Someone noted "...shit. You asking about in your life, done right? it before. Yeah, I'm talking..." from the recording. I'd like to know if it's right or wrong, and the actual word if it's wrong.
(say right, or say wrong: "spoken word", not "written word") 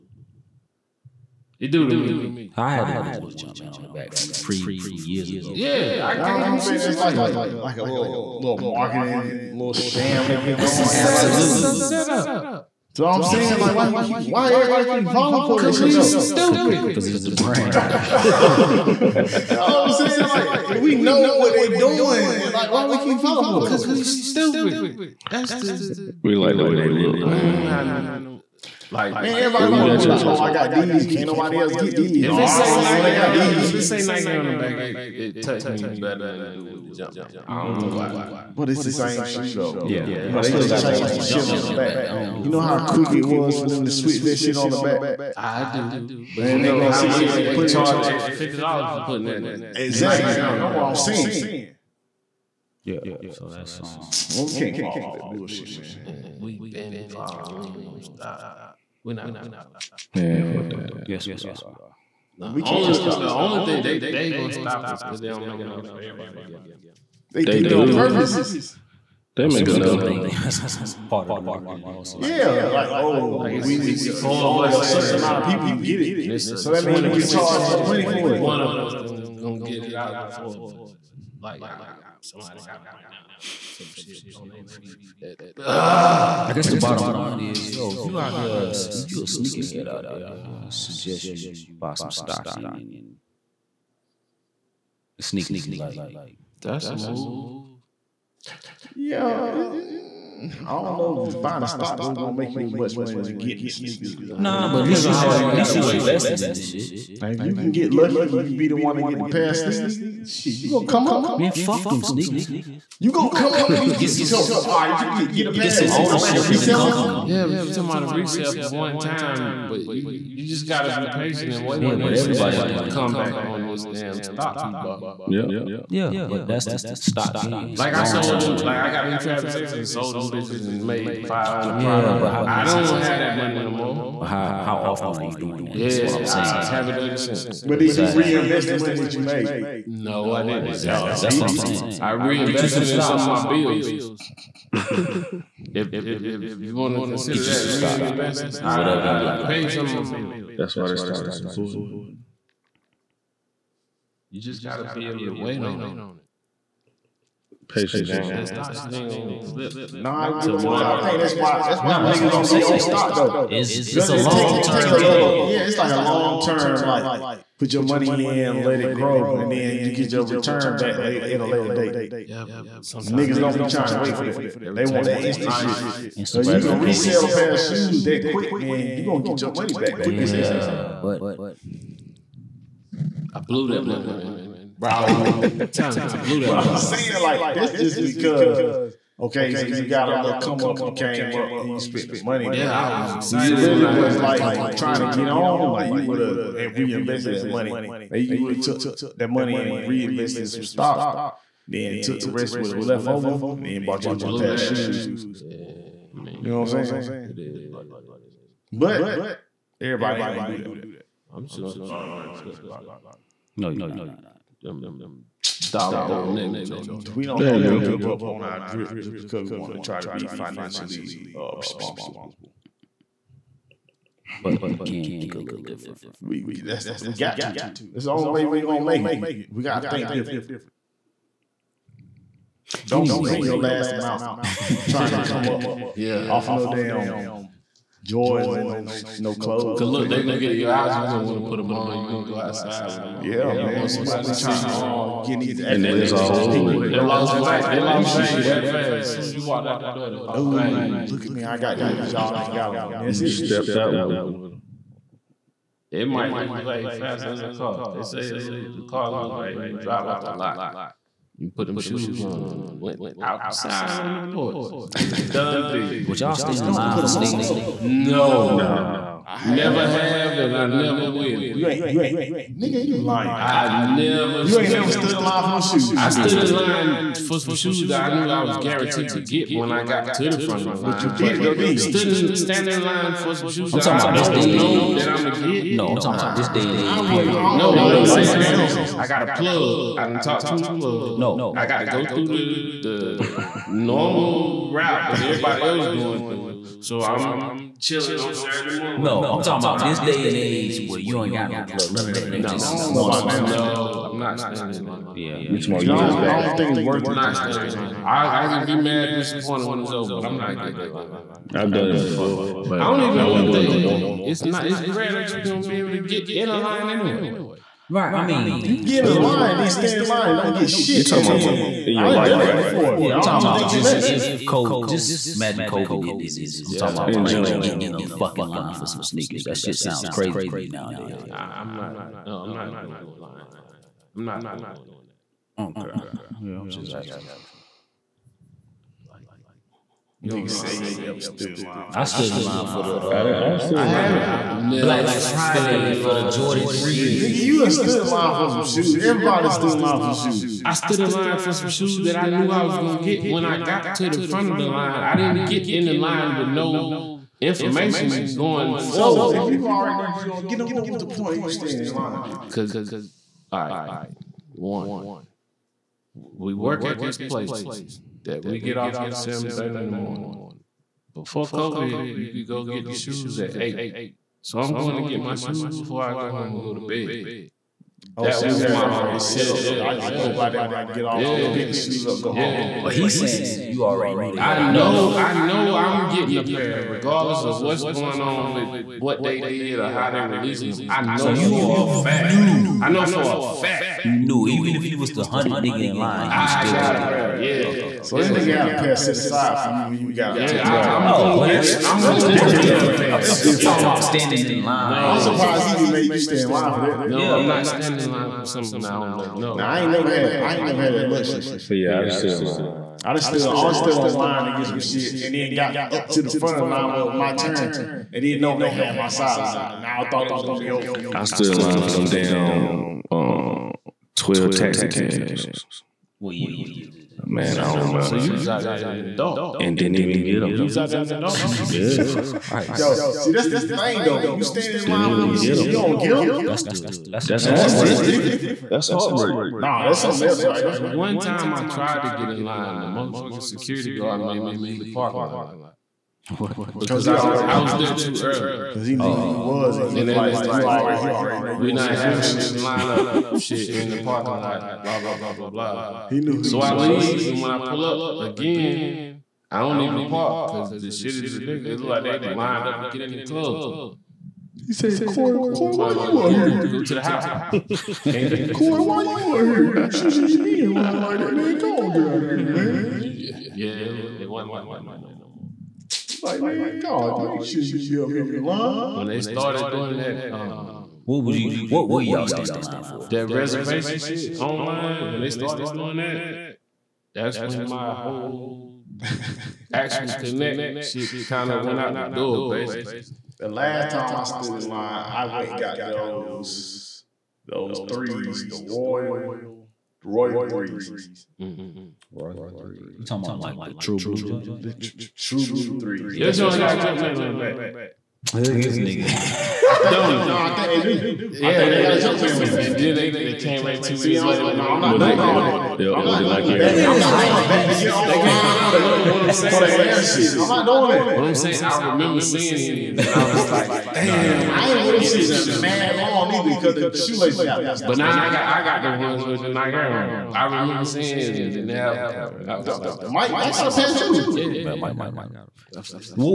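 wrong: "talking", not "asking".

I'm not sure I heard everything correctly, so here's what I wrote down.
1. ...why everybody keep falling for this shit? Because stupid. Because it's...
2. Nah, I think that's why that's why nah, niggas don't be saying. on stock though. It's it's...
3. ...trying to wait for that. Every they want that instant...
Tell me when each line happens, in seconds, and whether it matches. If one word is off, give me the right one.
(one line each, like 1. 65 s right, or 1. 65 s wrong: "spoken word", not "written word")
1. 14 s right
2. 159 s right
3. 173 s right.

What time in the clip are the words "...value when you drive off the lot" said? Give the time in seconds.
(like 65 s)
259 s.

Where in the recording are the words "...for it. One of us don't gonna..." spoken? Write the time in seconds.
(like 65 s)
78 s.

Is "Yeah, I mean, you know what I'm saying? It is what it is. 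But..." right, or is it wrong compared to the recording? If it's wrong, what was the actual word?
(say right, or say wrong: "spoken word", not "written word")
right.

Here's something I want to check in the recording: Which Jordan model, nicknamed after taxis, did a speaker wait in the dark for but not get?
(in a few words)
Taxi 12s.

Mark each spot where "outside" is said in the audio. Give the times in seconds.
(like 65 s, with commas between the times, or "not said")
242 s, 263 s.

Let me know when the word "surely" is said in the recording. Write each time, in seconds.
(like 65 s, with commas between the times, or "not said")
not said.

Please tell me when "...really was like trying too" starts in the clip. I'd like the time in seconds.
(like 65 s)
193 s.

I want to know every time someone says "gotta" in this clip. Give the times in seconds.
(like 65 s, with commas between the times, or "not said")
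120 s, 154 s.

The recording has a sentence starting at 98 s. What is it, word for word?
Yeah, it, I don't know if it's buying a stock though gonna make you as much money as getting the sneakers.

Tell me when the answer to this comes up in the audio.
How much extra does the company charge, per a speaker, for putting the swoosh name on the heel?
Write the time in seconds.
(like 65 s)
48 s.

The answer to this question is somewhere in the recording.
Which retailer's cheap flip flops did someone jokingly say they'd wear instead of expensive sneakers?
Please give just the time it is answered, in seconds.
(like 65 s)
216 s.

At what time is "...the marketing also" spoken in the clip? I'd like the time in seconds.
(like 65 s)
71 s.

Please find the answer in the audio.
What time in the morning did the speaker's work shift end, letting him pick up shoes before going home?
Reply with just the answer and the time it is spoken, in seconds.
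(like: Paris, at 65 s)
7:30, at 369 s.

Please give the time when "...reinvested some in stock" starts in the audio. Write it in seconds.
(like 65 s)
142 s.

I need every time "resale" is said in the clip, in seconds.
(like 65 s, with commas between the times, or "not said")
118 s.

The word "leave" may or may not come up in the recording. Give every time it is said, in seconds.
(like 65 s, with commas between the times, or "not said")
444 s, 456 s.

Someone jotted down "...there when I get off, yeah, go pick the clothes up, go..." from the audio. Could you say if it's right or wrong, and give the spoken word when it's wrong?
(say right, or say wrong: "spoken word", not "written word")
wrong: "shoes", not "clothes".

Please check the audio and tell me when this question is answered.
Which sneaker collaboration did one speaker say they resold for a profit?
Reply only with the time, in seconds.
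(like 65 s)
129 s.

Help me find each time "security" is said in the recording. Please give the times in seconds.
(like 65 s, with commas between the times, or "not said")
443 s.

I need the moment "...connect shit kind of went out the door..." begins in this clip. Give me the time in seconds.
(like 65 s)
490 s.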